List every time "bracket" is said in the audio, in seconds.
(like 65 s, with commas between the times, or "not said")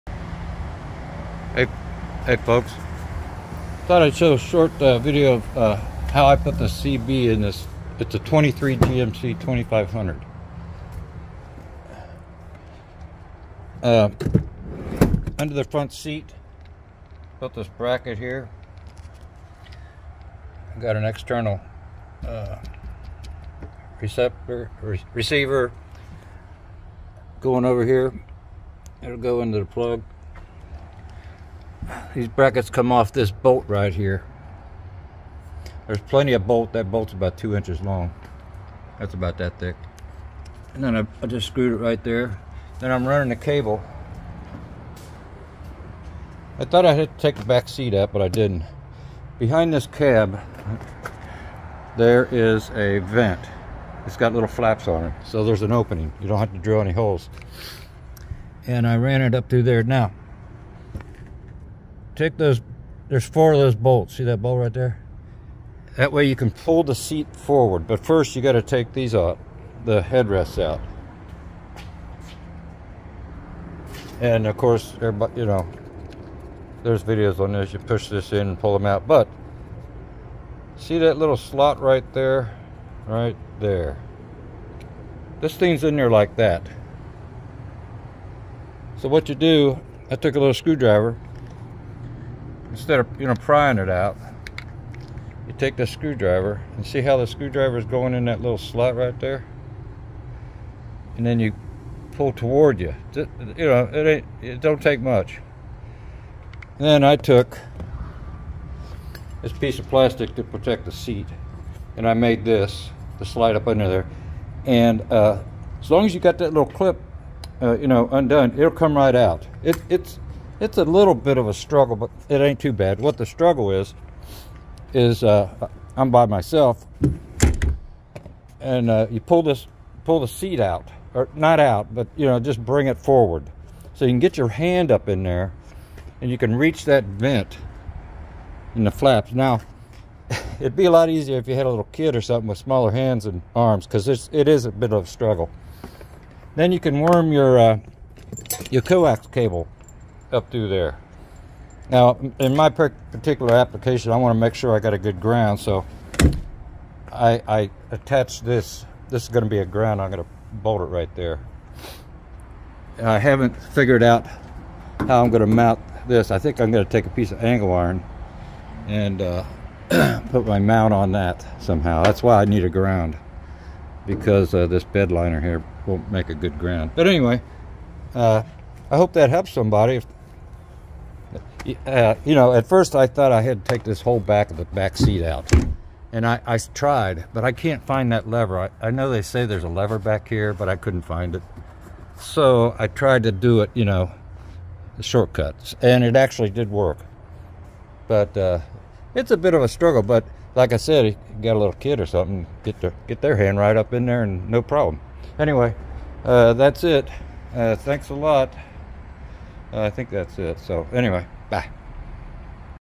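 17 s, 32 s.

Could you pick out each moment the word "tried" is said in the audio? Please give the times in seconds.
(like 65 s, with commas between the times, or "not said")
186 s, 192 s.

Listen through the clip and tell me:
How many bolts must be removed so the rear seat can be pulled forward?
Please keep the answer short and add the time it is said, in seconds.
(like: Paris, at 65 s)
4, at 63 s.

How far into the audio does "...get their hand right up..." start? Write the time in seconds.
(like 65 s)
203 s.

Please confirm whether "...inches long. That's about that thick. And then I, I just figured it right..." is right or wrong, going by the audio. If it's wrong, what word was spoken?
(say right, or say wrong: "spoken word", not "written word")
wrong: "screwed", not "figured".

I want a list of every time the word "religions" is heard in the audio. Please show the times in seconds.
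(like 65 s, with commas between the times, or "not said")
not said.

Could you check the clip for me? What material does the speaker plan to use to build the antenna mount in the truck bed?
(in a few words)
angle iron.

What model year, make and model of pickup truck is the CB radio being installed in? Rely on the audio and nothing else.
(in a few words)
2023 GMC 2500.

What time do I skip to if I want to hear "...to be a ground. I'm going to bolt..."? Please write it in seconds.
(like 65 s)
159 s.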